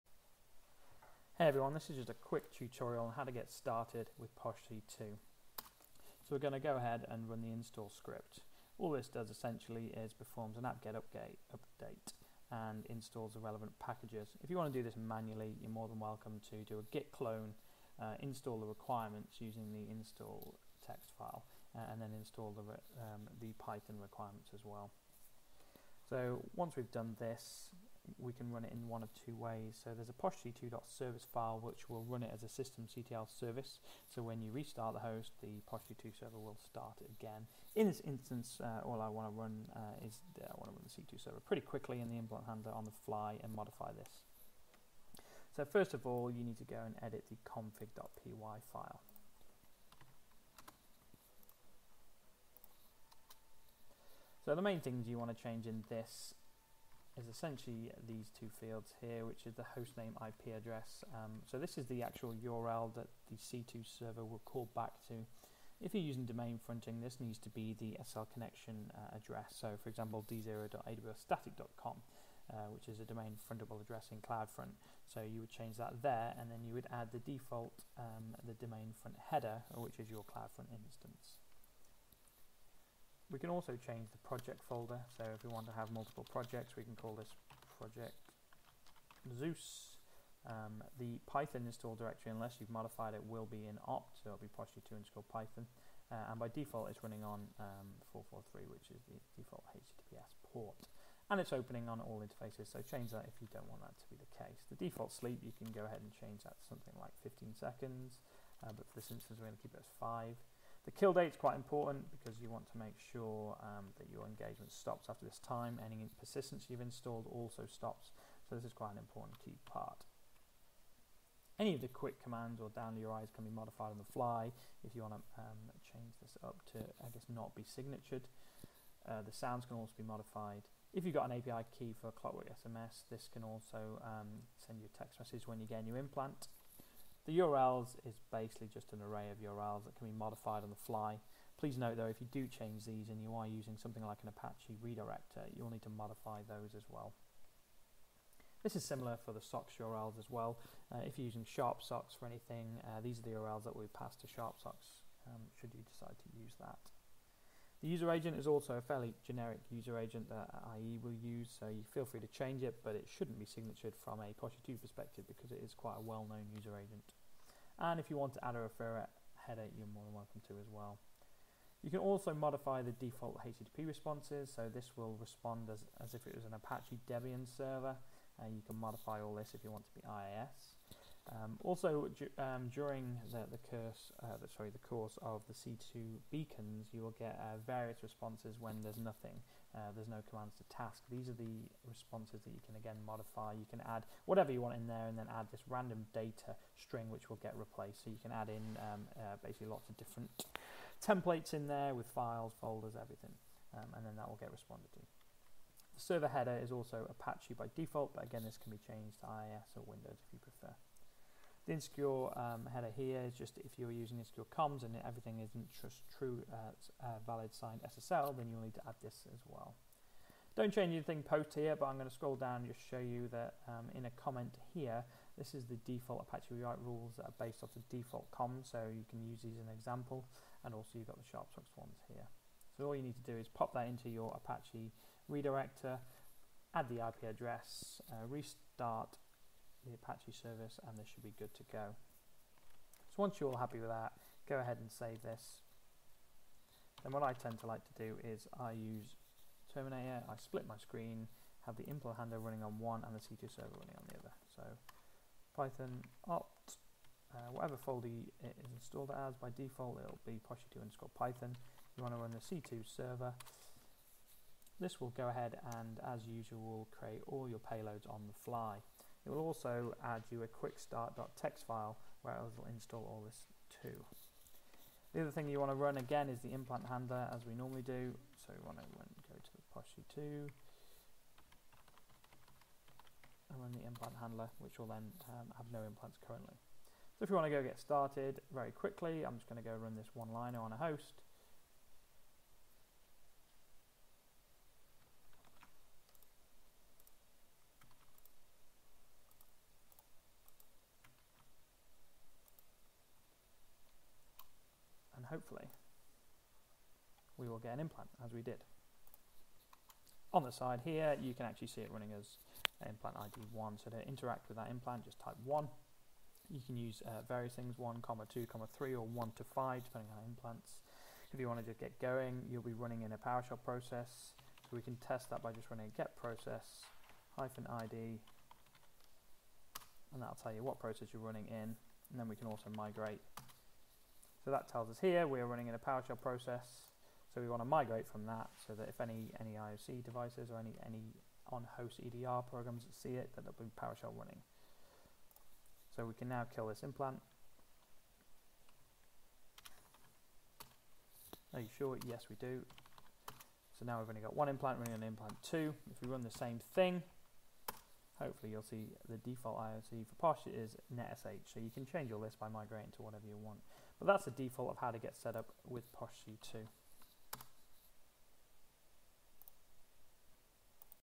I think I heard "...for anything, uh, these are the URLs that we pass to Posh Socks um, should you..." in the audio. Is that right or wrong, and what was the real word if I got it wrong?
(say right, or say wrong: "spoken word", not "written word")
wrong: "Sharp", not "Posh".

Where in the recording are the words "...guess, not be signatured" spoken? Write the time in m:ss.
2:07.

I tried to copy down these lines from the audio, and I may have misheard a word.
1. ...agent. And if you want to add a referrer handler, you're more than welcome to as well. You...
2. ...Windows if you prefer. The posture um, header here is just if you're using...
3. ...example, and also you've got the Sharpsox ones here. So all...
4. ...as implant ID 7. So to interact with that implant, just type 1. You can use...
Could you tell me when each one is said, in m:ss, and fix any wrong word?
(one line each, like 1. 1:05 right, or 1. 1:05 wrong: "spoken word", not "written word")
1. 2:46 wrong: "header", not "handler"
2. 3:29 wrong: "insecure", not "posture"
3. 3:49 right
4. 5:12 wrong: "1", not "7".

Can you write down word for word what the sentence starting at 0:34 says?
So when you restart the host, the posh2 server will start again.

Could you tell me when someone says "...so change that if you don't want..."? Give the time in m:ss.
1:42.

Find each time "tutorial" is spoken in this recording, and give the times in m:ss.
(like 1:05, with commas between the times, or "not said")
0:02.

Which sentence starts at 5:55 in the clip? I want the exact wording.
If we run the same thing, hopefully you'll see the default IOC for Posh is NetSH.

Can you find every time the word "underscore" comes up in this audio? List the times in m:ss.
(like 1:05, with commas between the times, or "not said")
1:34, 4:20.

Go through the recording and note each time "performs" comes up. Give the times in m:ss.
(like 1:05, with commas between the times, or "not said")
0:10.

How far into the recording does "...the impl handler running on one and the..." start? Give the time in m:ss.
4:11.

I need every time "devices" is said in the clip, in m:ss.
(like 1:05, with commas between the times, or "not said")
5:40.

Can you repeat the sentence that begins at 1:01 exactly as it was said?
Um, so this is the actual URL that the C2 server will call back to.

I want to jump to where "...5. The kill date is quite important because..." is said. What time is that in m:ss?
1:50.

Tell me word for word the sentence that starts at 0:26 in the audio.
So once we've done this, we can run it in one of two ways.